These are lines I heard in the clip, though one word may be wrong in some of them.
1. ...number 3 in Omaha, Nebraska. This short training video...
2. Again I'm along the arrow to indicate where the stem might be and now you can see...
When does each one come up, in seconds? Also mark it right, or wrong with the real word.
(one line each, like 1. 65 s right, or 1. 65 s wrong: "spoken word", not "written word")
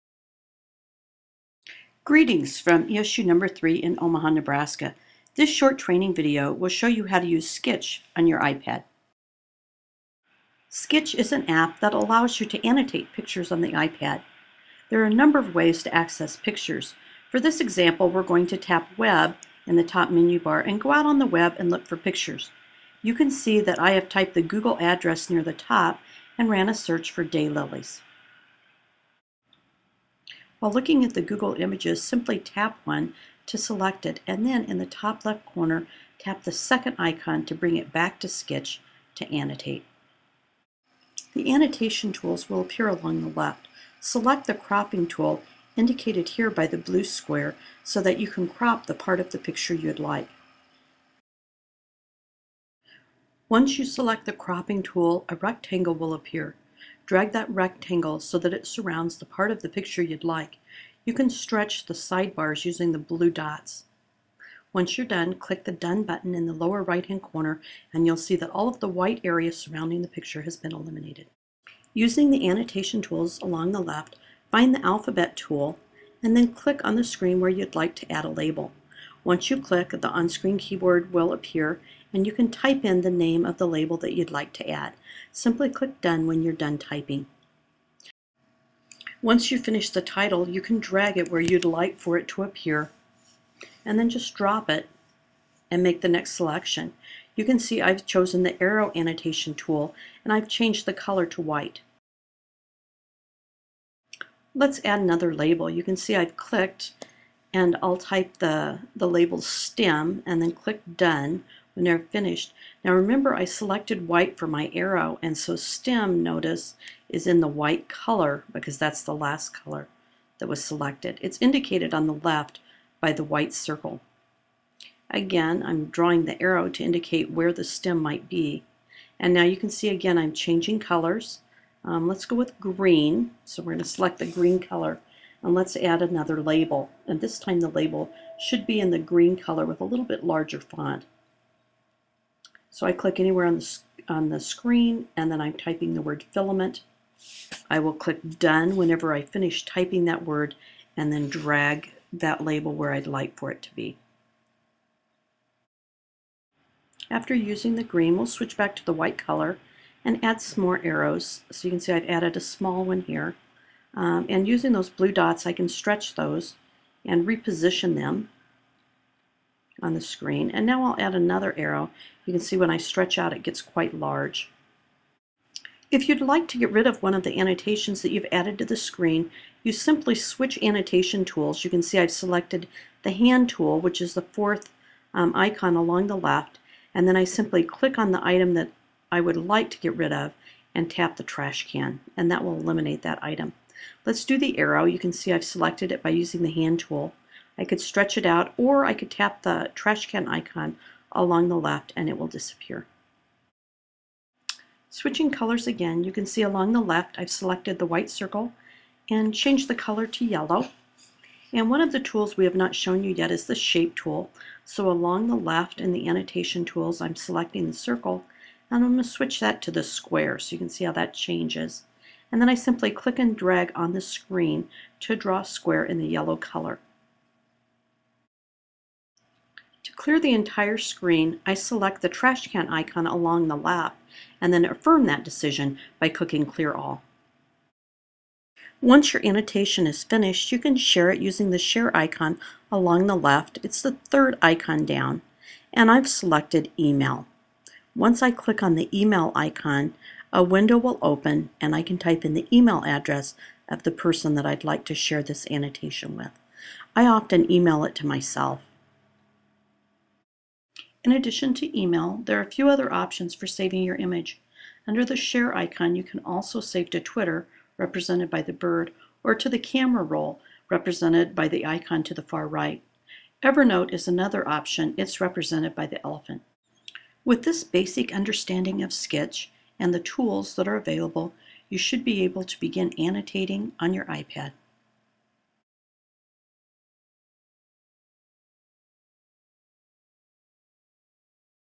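1. 3 s right
2. 125 s wrong: "drawing", not "along".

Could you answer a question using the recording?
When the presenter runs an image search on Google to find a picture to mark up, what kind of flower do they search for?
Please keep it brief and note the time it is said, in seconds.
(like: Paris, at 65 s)
daylilies, at 27 s.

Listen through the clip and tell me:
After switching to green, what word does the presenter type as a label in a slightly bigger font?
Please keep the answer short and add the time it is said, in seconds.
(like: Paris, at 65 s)
filament, at 146 s.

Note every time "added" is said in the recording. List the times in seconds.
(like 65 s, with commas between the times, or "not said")
162 s, 178 s.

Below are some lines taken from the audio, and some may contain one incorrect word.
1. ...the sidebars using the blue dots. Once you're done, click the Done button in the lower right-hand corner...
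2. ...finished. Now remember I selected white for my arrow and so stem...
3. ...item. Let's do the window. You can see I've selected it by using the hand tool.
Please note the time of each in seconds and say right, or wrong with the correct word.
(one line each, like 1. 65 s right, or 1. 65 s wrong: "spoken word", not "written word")
1. 61 s right
2. 112 s right
3. 193 s wrong: "arrow", not "window".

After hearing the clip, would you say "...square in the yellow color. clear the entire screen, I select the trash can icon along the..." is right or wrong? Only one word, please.
right.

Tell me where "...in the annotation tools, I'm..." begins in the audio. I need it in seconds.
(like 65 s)
215 s.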